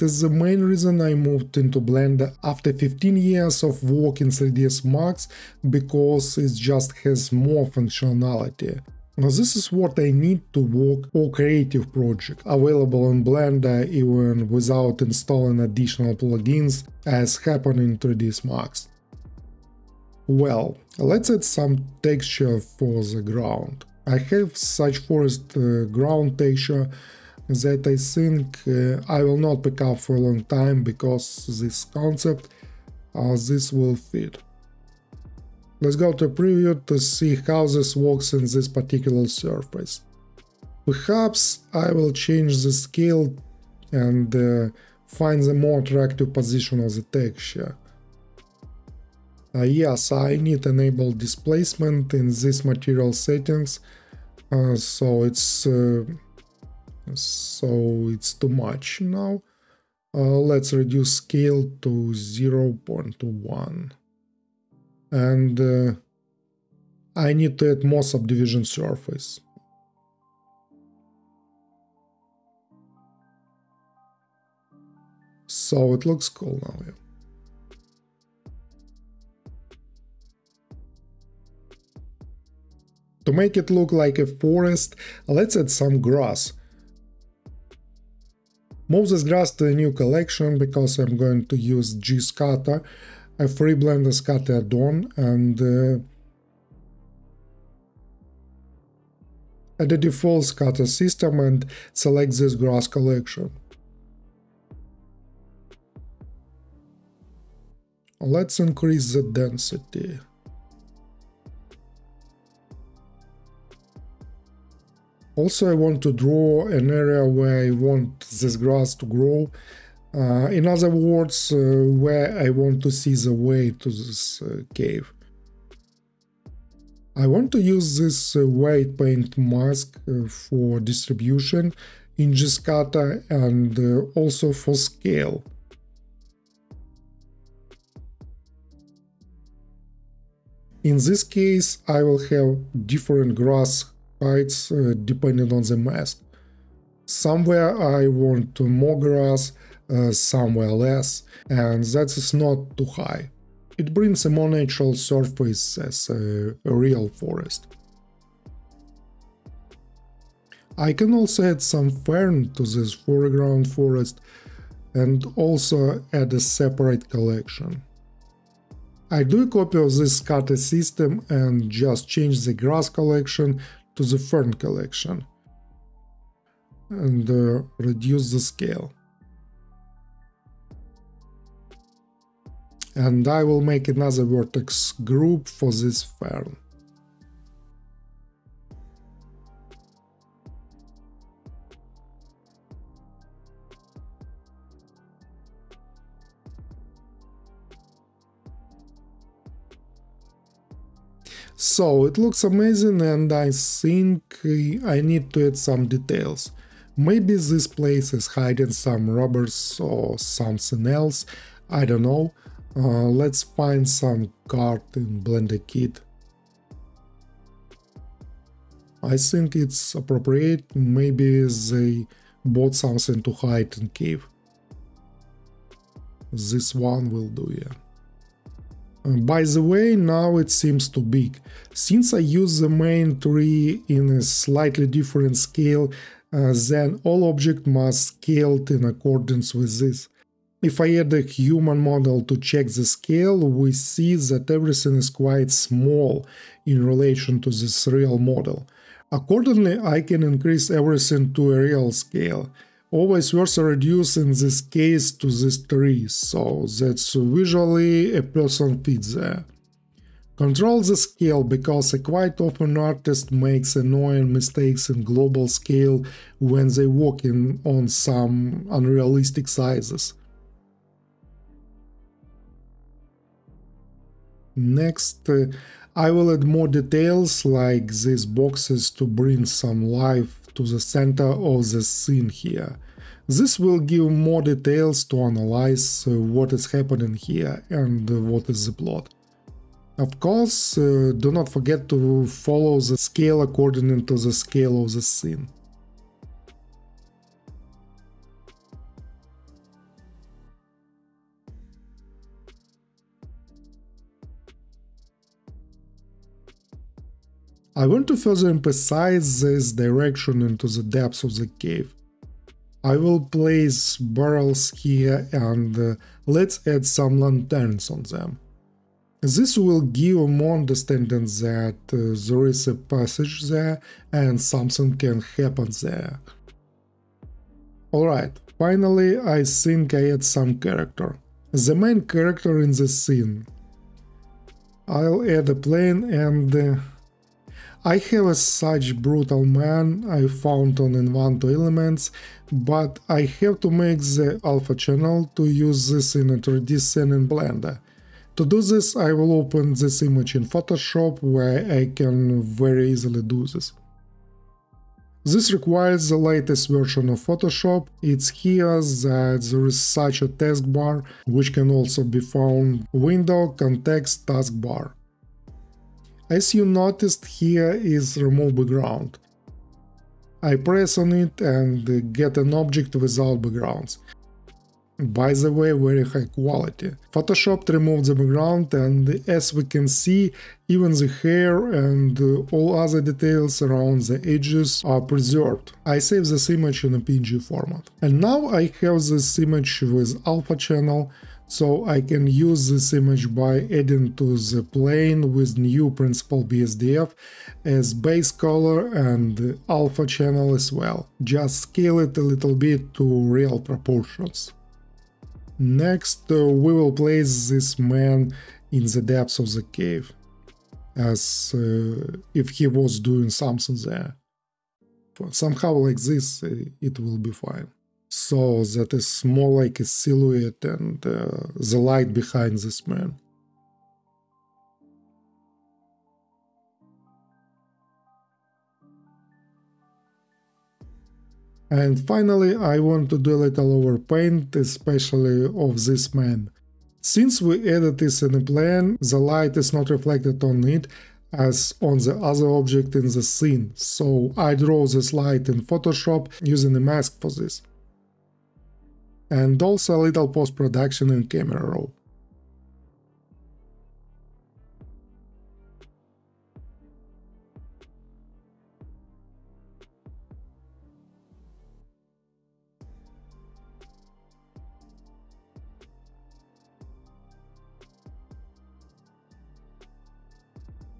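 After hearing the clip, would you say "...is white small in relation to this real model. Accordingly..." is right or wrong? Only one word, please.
wrong.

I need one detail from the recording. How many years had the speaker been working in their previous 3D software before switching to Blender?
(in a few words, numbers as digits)
15.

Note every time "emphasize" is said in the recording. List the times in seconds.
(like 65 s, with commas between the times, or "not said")
308 s.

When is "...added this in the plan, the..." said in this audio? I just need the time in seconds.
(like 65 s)
437 s.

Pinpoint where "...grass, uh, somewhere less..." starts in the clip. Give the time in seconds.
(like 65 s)
148 s.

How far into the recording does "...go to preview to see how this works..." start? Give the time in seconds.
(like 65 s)
35 s.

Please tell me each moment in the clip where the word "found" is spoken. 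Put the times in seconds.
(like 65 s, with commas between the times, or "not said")
340 s, 362 s.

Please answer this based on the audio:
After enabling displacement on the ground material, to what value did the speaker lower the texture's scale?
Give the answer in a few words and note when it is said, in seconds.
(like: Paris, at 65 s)
0.1, at 61 s.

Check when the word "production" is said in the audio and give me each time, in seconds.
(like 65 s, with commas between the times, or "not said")
450 s.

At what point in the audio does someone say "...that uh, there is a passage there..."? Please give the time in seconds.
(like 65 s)
321 s.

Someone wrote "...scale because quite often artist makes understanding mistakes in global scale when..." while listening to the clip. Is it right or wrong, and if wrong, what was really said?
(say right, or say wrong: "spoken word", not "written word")
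wrong: "annoying", not "understanding".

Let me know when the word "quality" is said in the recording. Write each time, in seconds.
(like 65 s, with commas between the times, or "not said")
376 s.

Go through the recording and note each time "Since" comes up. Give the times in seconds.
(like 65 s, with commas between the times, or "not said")
231 s, 437 s.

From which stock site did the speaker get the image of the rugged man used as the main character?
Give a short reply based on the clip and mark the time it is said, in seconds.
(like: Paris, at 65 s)
Envato Elements, at 340 s.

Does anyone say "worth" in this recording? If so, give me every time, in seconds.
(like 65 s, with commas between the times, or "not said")
253 s.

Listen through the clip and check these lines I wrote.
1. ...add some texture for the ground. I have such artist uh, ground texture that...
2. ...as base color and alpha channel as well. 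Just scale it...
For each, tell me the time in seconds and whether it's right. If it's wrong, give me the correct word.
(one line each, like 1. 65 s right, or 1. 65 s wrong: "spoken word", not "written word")
1. 21 s wrong: "forest", not "artist"
2. 397 s right.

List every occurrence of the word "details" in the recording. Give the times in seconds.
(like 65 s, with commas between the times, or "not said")
205 s, 276 s, 284 s, 383 s.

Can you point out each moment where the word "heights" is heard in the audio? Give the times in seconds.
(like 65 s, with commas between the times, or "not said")
144 s.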